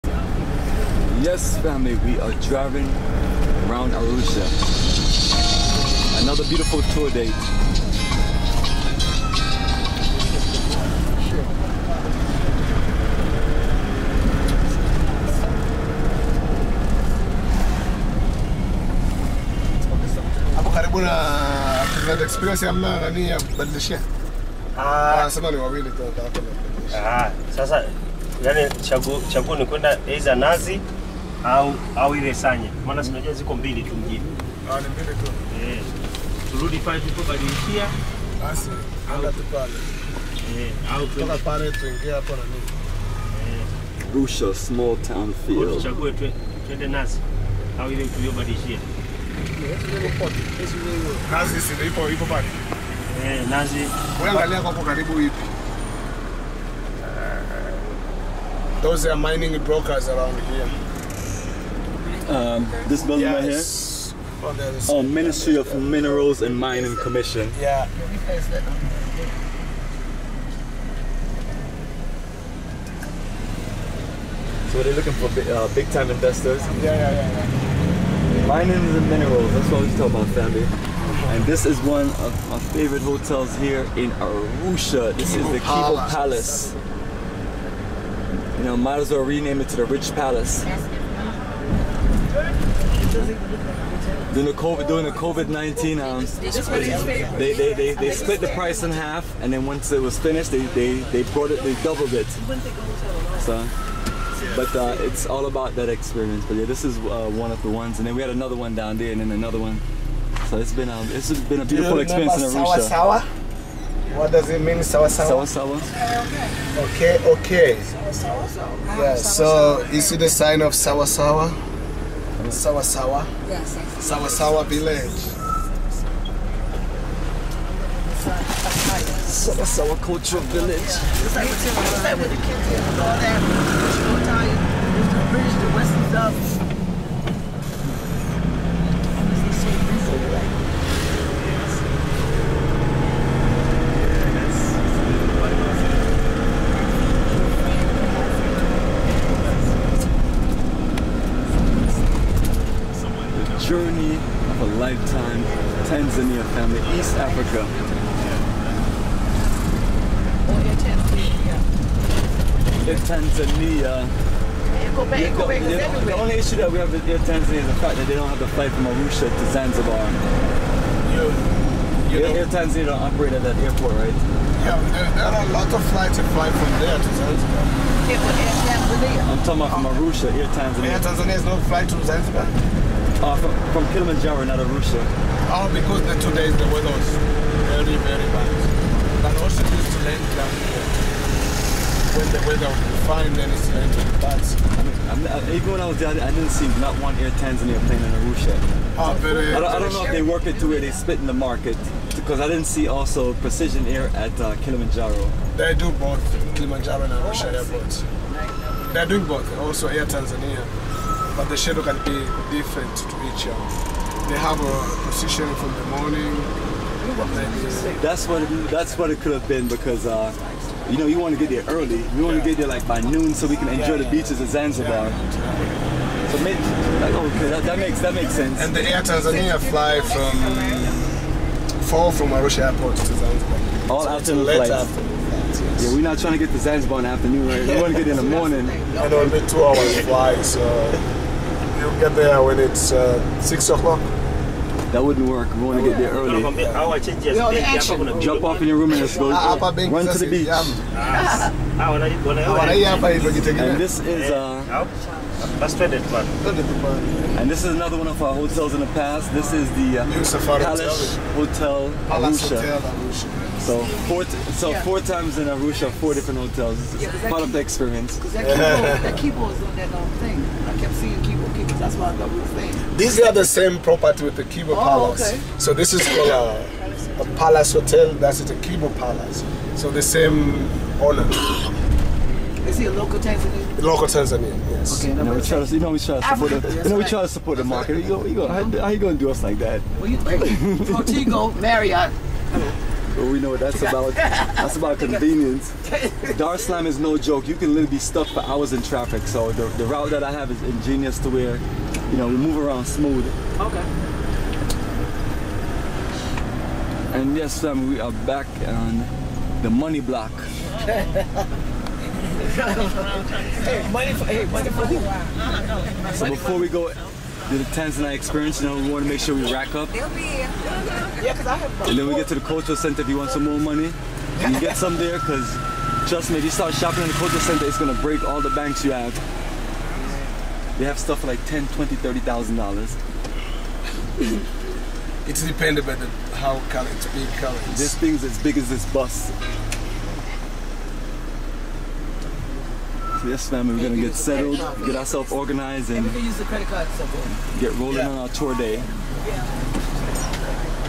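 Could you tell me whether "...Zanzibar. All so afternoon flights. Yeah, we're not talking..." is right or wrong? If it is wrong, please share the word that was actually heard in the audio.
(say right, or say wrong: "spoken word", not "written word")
wrong: "trying", not "talking".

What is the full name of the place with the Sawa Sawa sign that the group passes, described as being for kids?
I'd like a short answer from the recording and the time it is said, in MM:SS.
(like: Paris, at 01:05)
Sawa Sawa Cultural Village, at 02:09.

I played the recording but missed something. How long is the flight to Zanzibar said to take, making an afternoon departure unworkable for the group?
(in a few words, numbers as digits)
2 hours.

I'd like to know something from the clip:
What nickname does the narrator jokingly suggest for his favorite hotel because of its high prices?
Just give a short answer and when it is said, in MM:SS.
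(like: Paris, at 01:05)
Rich Palace, at 01:29.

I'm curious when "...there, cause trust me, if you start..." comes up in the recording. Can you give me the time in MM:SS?
05:24.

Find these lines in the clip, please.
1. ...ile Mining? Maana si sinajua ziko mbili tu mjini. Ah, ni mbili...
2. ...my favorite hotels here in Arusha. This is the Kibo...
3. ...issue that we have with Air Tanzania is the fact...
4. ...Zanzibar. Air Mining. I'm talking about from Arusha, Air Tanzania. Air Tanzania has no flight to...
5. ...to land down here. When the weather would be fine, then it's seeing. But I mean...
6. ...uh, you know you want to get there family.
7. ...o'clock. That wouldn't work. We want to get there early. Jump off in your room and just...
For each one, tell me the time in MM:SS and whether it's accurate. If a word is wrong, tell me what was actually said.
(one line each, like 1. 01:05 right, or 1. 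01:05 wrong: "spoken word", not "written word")
1. 00:32 wrong: "Sanya", not "Mining"
2. 01:22 right
3. 02:46 right
4. 02:57 wrong: "Tanzania", not "Mining"
5. 03:09 wrong: "landing", not "seeing"
6. 03:40 wrong: "early", not "family"
7. 04:03 right.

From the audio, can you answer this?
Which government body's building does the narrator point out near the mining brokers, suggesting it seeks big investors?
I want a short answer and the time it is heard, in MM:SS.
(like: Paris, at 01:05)
Mining Commission, at 01:06.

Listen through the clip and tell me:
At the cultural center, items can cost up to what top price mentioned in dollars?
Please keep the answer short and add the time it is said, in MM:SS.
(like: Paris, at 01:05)
$30,000, at 05:31.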